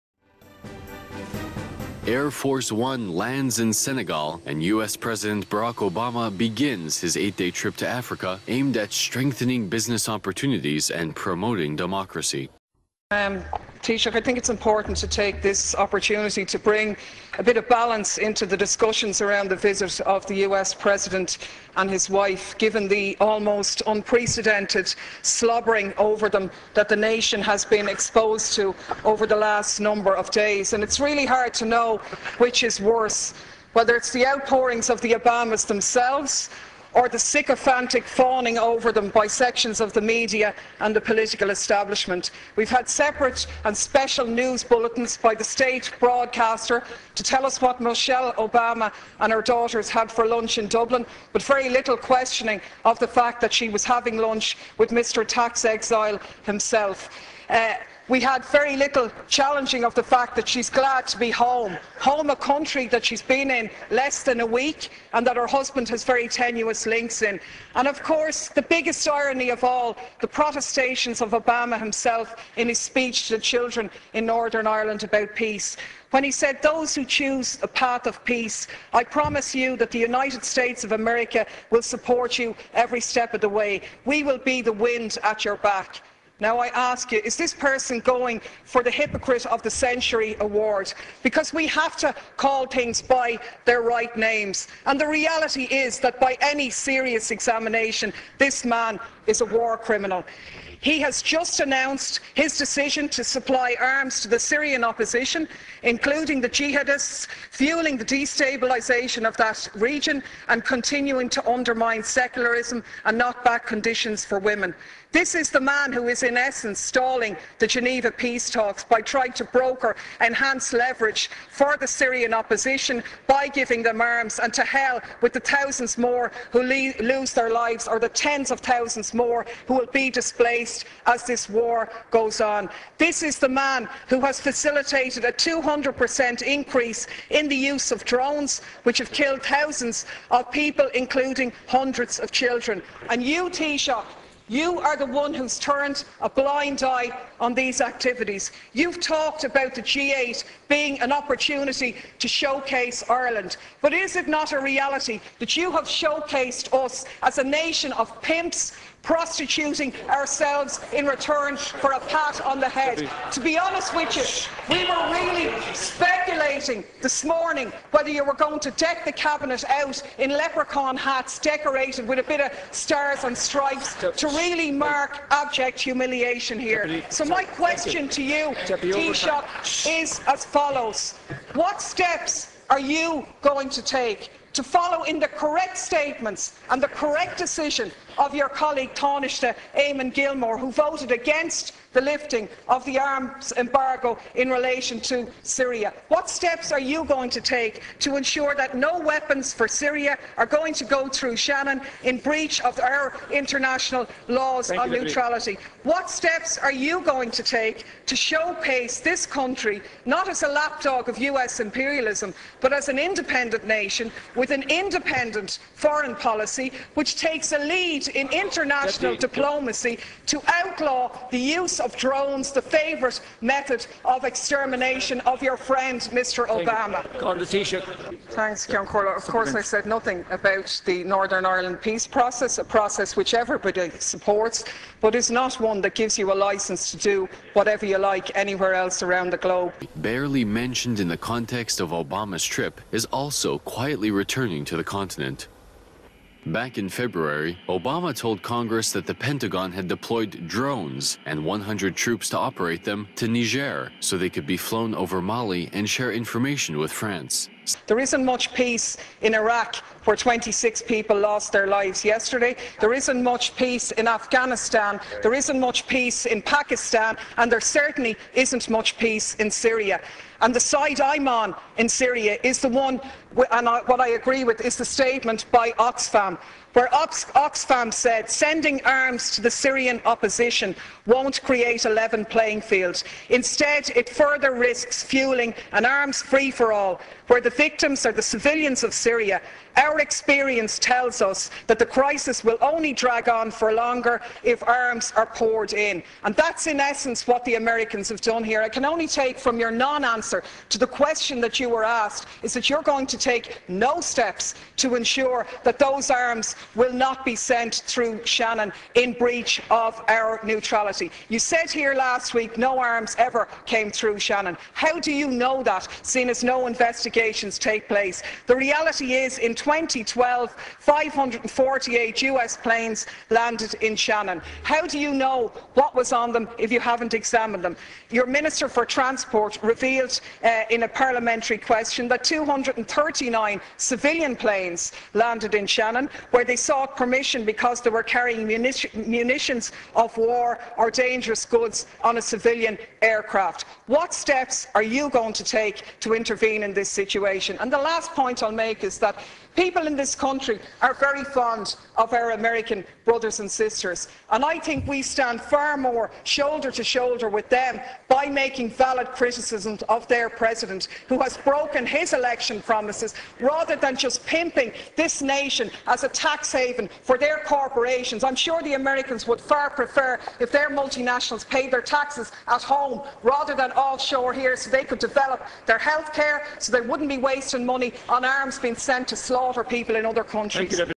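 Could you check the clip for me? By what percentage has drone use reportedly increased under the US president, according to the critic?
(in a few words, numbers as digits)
200%.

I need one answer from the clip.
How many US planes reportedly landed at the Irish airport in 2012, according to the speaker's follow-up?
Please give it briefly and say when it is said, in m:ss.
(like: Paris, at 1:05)
548, at 5:20.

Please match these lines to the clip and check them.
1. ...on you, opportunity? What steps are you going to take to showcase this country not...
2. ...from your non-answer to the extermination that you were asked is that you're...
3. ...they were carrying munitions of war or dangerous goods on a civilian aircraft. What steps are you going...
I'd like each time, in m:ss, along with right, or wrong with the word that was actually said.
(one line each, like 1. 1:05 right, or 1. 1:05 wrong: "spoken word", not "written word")
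1. 3:24 wrong: "neutrality", not "opportunity"
2. 4:59 wrong: "question", not "extermination"
3. 5:37 right.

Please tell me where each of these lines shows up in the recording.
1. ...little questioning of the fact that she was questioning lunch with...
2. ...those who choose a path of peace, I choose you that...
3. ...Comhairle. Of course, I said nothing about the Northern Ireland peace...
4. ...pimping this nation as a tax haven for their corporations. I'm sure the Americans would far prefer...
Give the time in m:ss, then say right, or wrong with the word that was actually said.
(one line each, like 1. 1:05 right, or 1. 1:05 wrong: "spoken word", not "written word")
1. 0:51 wrong: "having", not "questioning"
2. 1:16 wrong: "promise", not "choose"
3. 3:48 right
4. 6:04 right.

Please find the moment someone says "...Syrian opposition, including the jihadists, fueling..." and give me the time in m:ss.
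1:44.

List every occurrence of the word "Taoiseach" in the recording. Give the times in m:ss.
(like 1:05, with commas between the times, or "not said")
0:13, 2:23, 2:58, 3:08.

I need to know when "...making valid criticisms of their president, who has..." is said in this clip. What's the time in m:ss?
5:58.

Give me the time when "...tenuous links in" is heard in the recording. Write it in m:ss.
1:06.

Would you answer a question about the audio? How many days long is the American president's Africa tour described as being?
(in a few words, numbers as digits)
8.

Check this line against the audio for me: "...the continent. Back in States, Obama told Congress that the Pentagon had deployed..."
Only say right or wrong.
wrong.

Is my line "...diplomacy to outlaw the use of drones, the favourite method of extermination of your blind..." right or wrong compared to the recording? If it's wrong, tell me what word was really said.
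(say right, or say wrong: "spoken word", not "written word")
wrong: "friend", not "blind".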